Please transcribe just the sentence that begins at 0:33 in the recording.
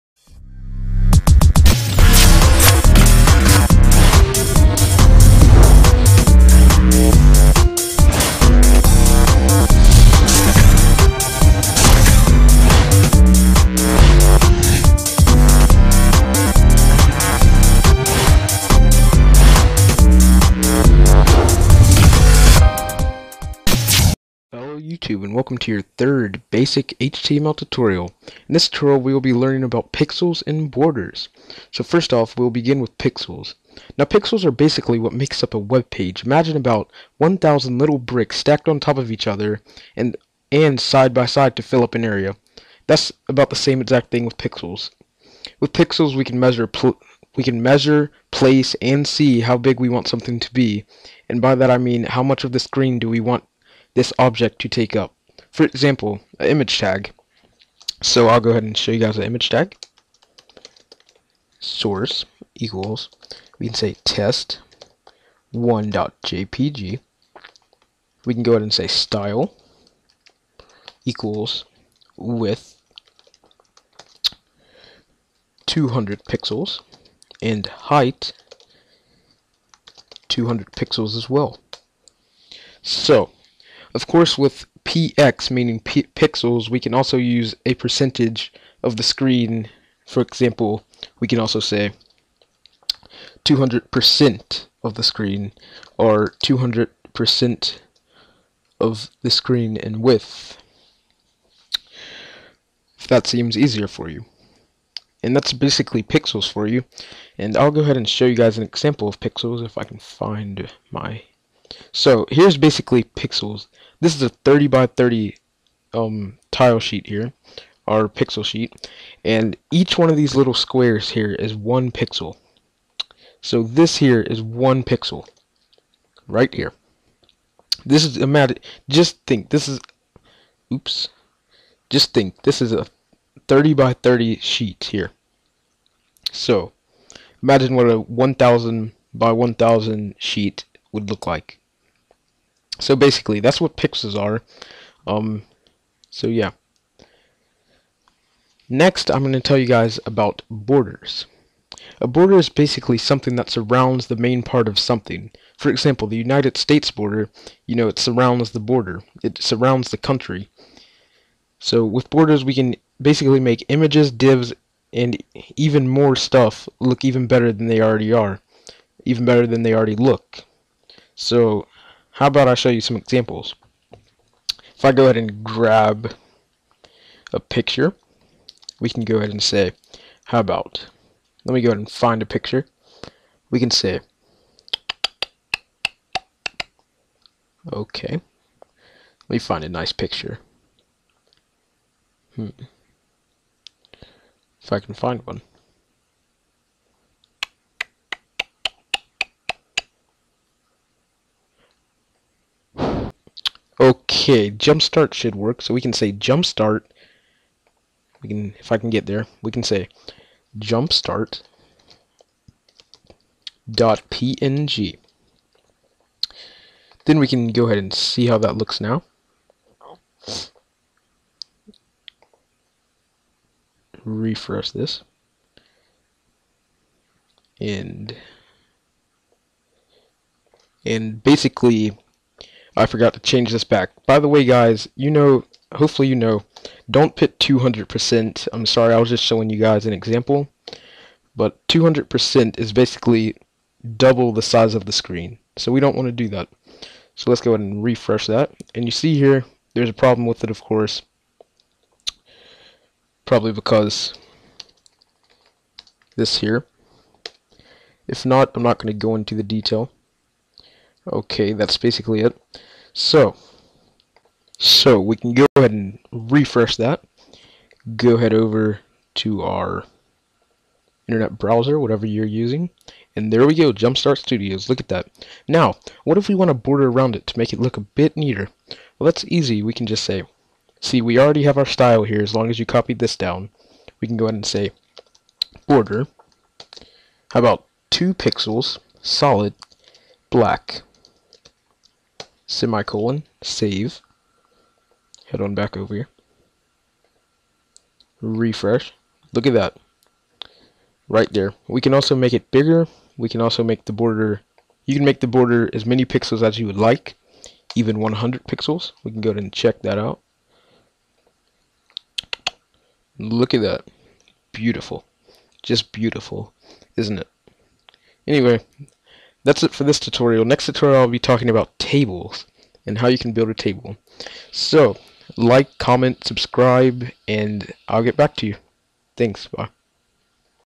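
Now pixels are basically what makes up a web page.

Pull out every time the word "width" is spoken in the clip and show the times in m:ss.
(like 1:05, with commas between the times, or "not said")
1:12, 1:40.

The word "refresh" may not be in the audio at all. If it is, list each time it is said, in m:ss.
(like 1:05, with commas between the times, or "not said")
3:44, 4:07, 4:26, 4:58.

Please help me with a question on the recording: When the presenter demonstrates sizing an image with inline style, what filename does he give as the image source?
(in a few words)
test1.jpg.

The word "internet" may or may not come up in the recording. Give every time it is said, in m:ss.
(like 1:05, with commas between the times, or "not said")
4:31.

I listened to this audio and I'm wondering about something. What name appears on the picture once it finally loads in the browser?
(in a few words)
Jumpstart Studios.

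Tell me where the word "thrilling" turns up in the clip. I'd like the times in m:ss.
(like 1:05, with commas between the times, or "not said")
not said.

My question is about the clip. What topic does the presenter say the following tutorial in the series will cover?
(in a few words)
tables.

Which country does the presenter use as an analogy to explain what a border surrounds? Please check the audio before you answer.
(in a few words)
United States.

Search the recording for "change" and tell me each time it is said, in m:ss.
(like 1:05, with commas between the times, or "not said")
3:53.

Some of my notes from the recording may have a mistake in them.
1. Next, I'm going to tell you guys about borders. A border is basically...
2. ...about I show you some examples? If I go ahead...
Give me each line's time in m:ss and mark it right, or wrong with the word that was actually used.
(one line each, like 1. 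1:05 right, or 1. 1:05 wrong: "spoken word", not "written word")
1. 2:28 right
2. 2:52 right.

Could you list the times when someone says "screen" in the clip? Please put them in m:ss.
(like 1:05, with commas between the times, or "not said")
0:52, 1:29, 1:35, 1:39, 4:04.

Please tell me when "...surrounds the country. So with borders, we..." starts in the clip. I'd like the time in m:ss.
2:39.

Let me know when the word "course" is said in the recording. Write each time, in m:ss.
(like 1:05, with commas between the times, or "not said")
1:24, 4:10.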